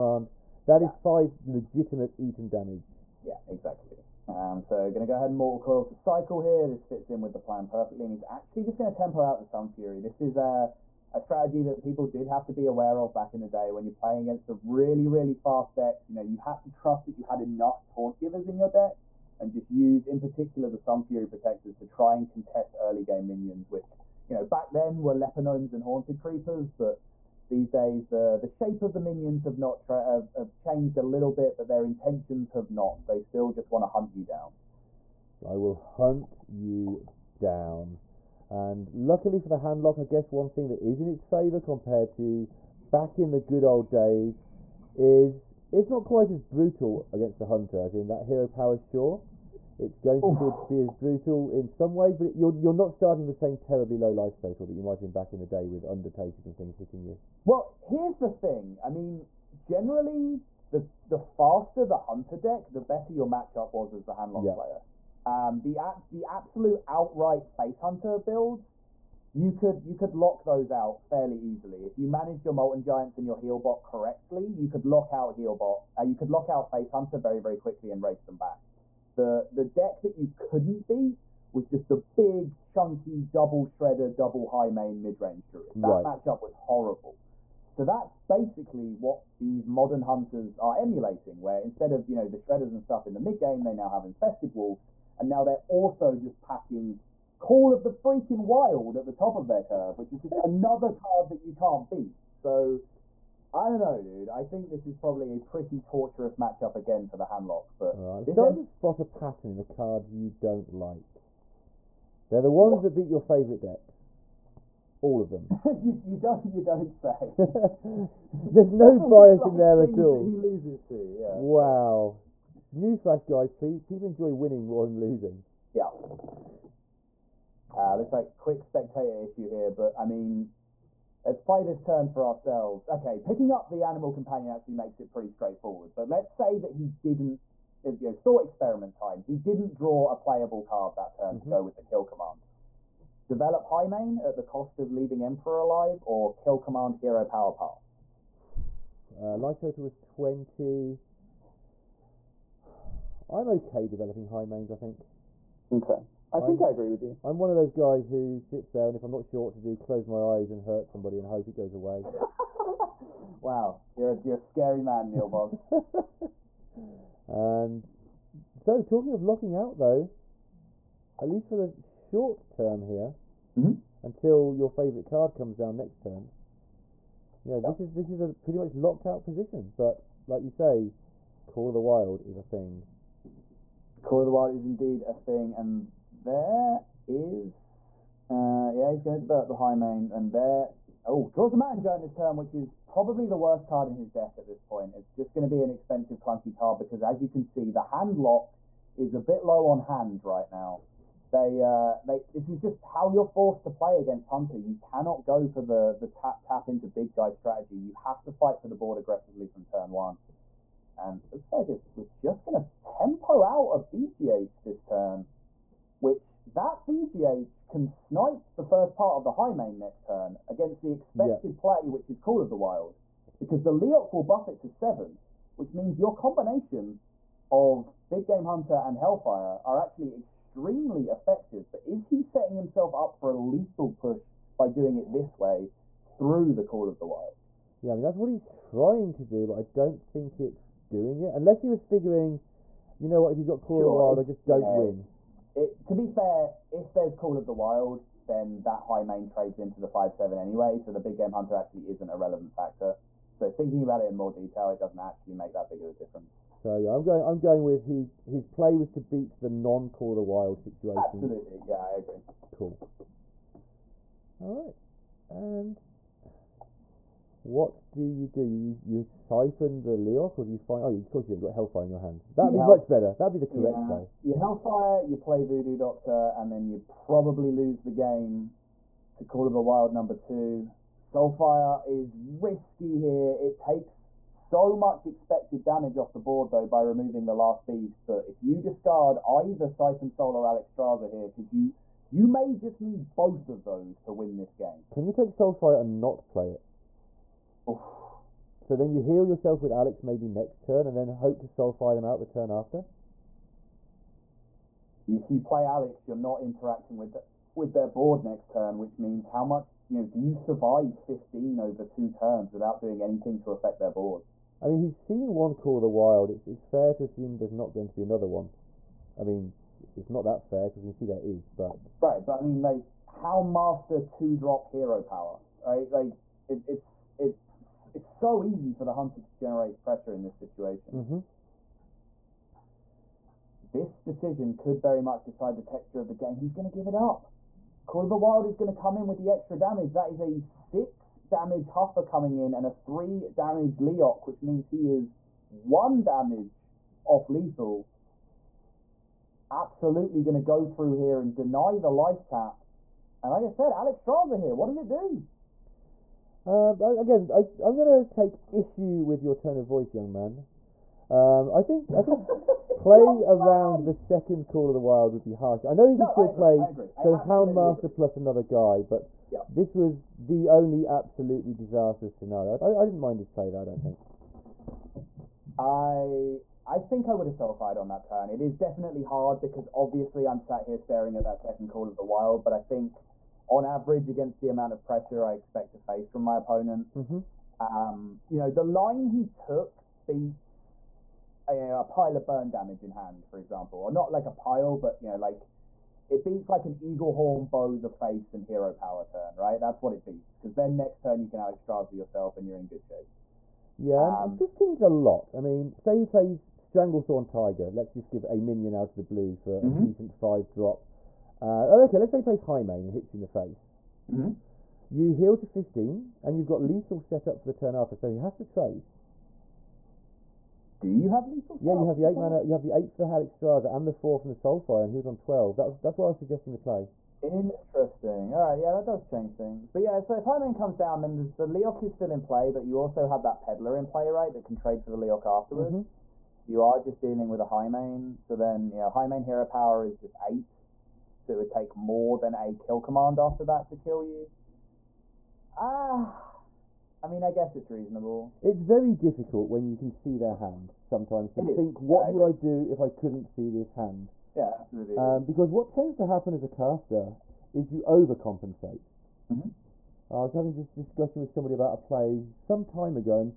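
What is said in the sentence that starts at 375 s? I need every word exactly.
I I think I would have solidified on that turn.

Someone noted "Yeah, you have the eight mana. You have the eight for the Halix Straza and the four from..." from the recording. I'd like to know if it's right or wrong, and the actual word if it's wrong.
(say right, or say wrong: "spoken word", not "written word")
right.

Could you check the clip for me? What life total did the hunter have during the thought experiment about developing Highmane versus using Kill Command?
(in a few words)
20.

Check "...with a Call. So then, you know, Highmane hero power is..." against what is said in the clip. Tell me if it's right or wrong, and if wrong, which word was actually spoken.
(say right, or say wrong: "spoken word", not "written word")
wrong: "Highmane", not "Call".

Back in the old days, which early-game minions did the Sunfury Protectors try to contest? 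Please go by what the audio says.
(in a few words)
Haunted Creepers.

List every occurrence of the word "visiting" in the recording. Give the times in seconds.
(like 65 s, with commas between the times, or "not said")
not said.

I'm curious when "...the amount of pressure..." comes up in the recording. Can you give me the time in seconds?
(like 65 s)
384 s.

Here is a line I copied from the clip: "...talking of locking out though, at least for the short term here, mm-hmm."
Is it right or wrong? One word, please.
right.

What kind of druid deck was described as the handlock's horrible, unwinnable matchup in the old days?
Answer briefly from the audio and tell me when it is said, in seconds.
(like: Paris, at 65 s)
Mid range druid, at 84 s.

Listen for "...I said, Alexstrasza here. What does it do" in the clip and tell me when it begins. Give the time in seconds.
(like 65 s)
353 s.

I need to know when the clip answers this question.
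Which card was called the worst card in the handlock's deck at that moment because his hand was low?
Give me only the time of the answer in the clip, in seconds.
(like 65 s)
191 s.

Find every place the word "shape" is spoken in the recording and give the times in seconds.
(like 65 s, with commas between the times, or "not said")
28 s, 402 s.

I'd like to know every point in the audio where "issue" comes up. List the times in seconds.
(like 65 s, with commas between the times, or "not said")
129 s, 358 s.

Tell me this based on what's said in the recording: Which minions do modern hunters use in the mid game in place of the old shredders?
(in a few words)
Infested wolves.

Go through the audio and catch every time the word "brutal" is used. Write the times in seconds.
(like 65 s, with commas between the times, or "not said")
46 s, 50 s.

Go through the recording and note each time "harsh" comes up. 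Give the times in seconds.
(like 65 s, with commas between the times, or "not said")
365 s.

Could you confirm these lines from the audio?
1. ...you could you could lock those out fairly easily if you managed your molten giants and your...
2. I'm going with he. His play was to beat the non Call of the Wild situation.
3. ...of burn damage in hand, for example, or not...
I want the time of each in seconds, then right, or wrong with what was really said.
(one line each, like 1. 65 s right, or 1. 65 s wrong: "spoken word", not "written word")
1. 69 s right
2. 257 s right
3. 392 s right.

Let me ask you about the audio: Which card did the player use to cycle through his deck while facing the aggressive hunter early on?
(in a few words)
Mortal Coil.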